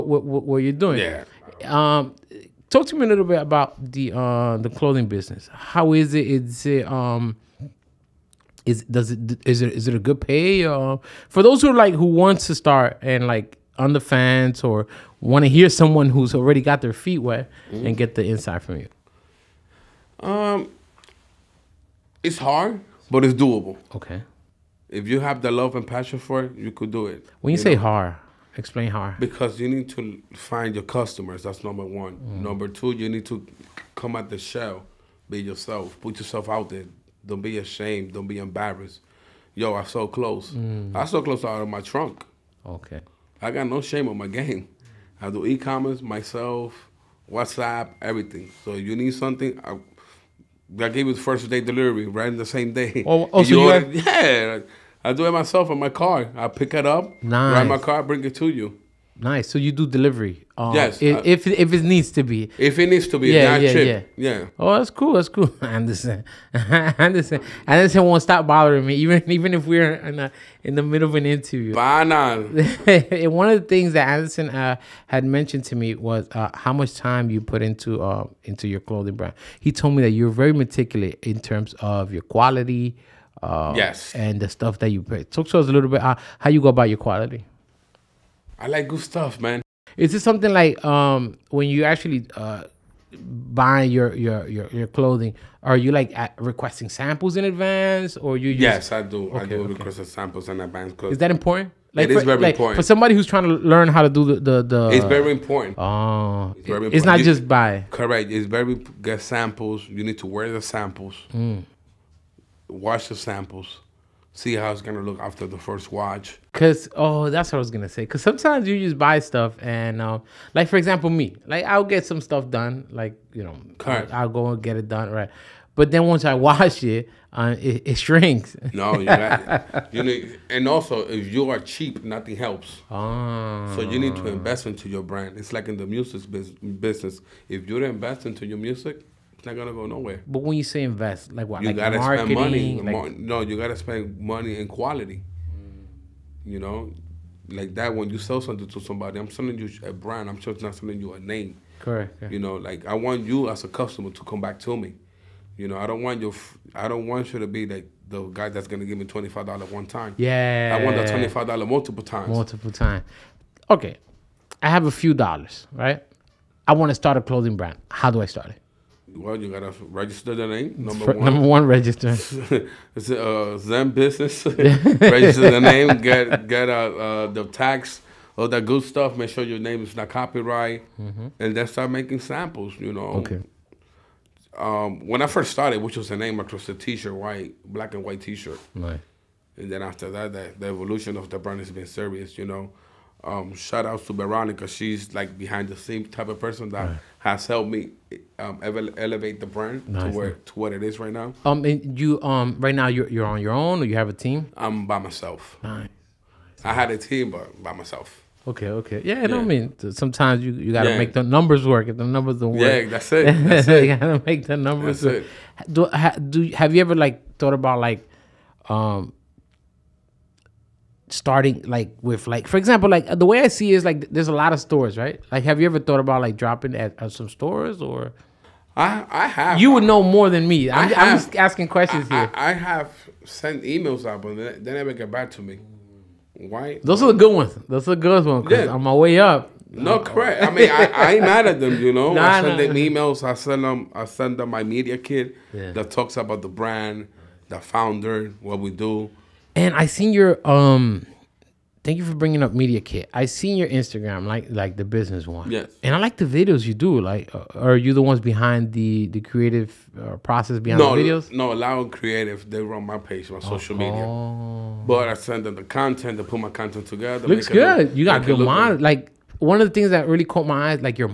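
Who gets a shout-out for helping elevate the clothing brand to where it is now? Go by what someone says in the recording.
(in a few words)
Veronica.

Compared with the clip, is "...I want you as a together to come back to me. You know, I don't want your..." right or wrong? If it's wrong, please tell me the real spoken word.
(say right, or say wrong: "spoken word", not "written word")
wrong: "customer", not "together".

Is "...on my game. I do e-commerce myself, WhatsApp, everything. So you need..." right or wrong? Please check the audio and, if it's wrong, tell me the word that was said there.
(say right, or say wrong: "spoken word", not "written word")
right.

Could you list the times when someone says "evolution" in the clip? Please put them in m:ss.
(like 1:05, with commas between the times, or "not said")
3:10.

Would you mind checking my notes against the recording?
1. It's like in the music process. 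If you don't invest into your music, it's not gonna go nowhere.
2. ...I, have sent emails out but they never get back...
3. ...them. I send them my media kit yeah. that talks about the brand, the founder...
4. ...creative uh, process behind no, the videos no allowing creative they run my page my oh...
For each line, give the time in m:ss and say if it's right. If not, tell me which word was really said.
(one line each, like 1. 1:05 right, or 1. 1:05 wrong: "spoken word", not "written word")
1. 2:15 wrong: "business", not "process"
2. 3:52 right
3. 4:03 right
4. 4:19 right.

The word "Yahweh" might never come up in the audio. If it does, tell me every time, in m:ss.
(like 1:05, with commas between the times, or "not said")
not said.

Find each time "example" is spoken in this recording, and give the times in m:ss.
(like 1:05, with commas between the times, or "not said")
2:00, 3:42.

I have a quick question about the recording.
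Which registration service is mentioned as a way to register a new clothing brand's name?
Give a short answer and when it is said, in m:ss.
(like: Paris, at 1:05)
ZenBusiness, at 2:53.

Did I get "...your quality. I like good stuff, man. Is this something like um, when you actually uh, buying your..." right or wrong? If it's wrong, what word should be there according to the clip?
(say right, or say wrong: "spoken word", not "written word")
right.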